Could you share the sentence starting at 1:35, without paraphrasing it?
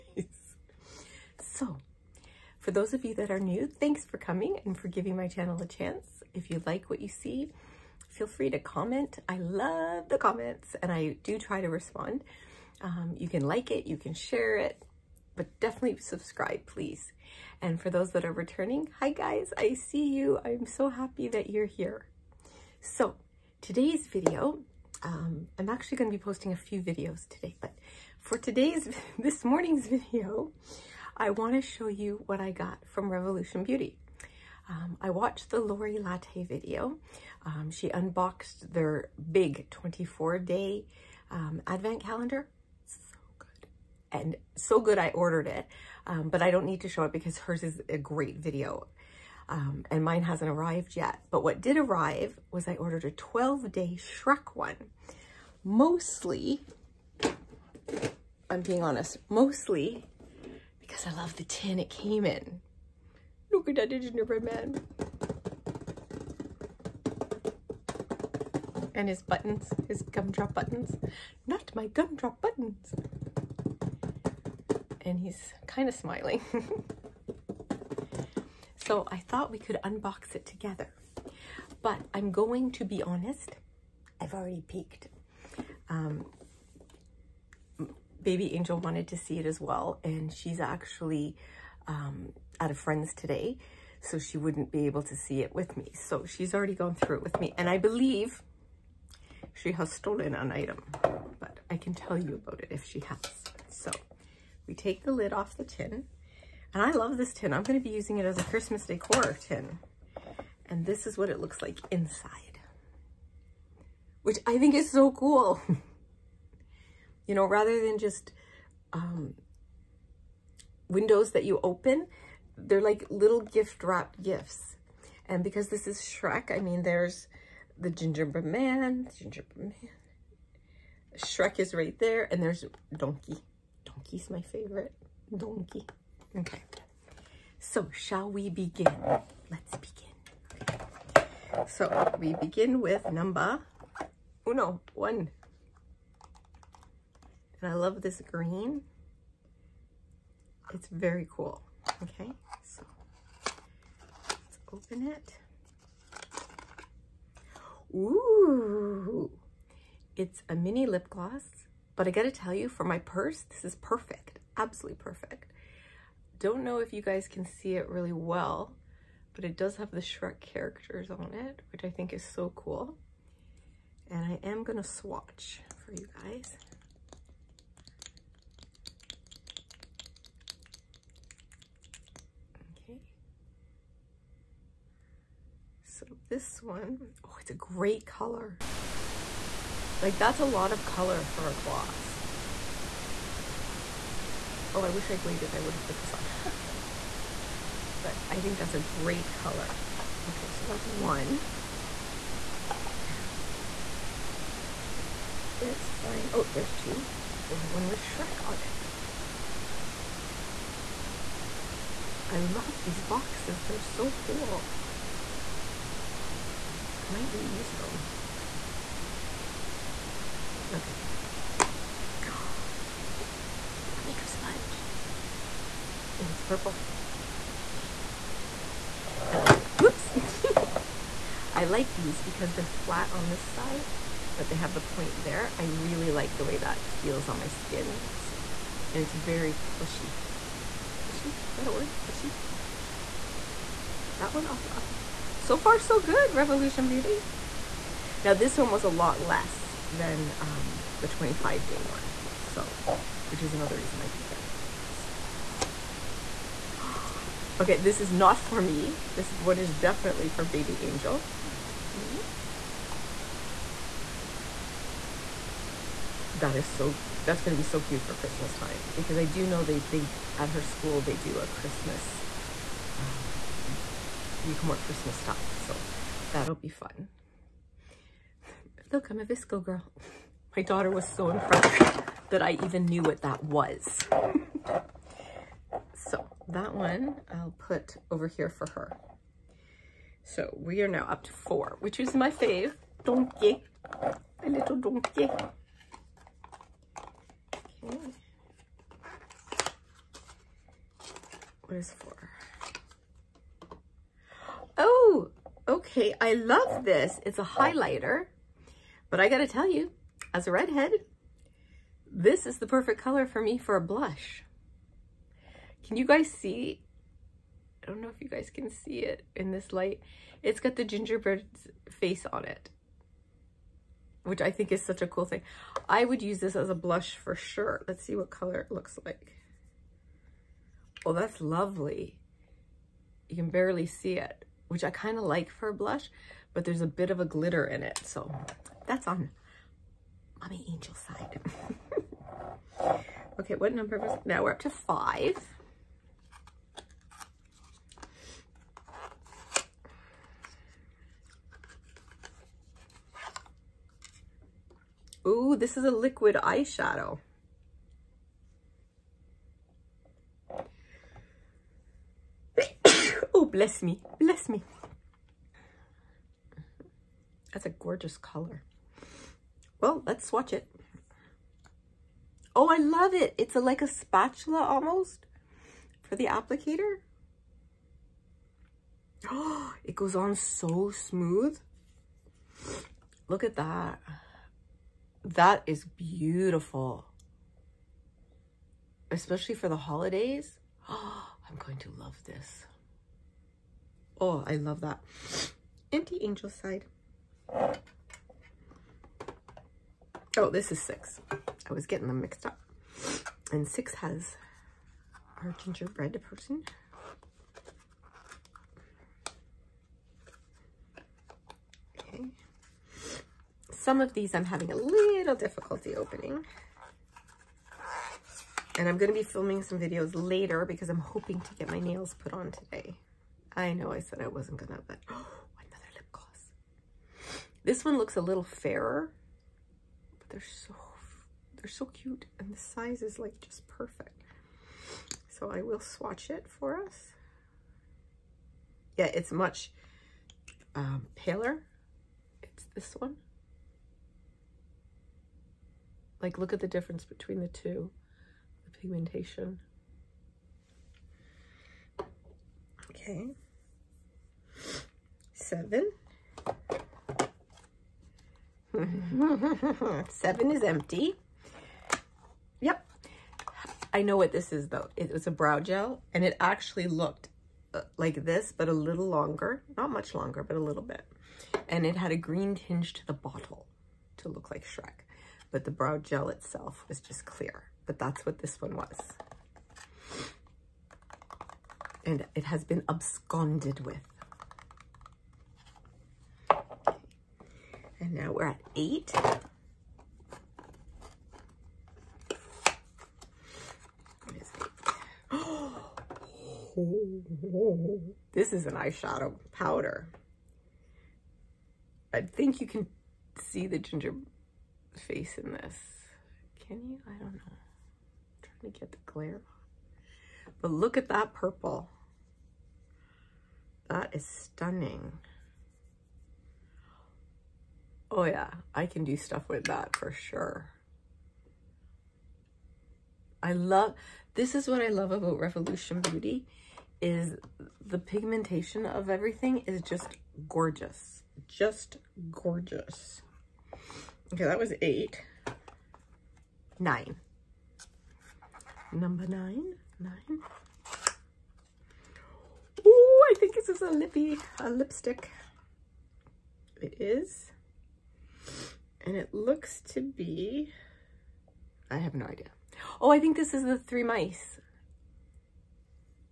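So she's already gone through it with me.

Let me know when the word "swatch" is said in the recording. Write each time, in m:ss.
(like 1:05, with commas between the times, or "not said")
2:54, 6:10, 7:15.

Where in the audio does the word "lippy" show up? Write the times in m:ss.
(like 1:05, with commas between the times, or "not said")
9:03.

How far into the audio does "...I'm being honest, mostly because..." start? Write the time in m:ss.
0:58.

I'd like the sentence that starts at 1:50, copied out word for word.
And this is what it looks like inside, which I think is so cool.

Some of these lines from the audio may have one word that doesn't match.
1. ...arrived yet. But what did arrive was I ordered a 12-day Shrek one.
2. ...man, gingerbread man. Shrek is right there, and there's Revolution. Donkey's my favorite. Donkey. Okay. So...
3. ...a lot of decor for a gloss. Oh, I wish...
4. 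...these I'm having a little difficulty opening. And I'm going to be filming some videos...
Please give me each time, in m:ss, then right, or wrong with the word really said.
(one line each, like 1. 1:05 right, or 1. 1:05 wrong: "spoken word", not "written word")
1. 0:50 right
2. 2:08 wrong: "Donkey", not "Revolution"
3. 3:10 wrong: "color", not "decor"
4. 6:54 right.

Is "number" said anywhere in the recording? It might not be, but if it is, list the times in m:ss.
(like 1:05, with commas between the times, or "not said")
2:23, 4:21, 5:43, 8:58.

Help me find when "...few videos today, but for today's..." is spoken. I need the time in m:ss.
0:26.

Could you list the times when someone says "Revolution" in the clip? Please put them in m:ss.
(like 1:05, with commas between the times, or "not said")
0:33, 4:06, 8:45.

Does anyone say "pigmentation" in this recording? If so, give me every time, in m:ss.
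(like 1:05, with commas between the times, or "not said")
7:28, 8:47.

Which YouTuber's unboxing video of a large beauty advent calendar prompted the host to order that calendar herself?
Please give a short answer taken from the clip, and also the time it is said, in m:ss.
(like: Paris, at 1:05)
Lorri Latte, at 0:35.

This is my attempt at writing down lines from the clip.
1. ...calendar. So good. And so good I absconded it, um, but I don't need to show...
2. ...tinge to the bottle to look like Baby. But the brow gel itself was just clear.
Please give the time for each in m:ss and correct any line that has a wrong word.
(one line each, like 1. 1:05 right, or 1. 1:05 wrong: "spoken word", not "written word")
1. 0:42 wrong: "ordered", not "absconded"
2. 7:52 wrong: "Shrek", not "Baby".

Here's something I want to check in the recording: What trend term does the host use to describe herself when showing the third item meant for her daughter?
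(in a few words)
VSCO girl.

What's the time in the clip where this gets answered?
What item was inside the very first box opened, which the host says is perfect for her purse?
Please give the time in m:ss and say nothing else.
2:40.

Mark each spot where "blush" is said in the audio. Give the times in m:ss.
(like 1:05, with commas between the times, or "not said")
5:13, 5:26, 5:35.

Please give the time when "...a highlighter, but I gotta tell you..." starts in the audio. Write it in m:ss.
5:07.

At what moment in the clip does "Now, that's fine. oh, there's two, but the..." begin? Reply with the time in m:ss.
3:22.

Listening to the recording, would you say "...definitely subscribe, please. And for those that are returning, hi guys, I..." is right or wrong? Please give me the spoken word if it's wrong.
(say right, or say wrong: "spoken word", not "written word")
right.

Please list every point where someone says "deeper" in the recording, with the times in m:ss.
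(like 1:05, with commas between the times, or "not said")
not said.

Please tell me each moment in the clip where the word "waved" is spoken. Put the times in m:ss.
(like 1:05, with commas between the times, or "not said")
not said.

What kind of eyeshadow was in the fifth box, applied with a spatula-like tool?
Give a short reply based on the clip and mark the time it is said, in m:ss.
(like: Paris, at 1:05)
liquid eyeshadow, at 5:55.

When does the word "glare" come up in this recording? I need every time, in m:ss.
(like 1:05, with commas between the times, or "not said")
8:29.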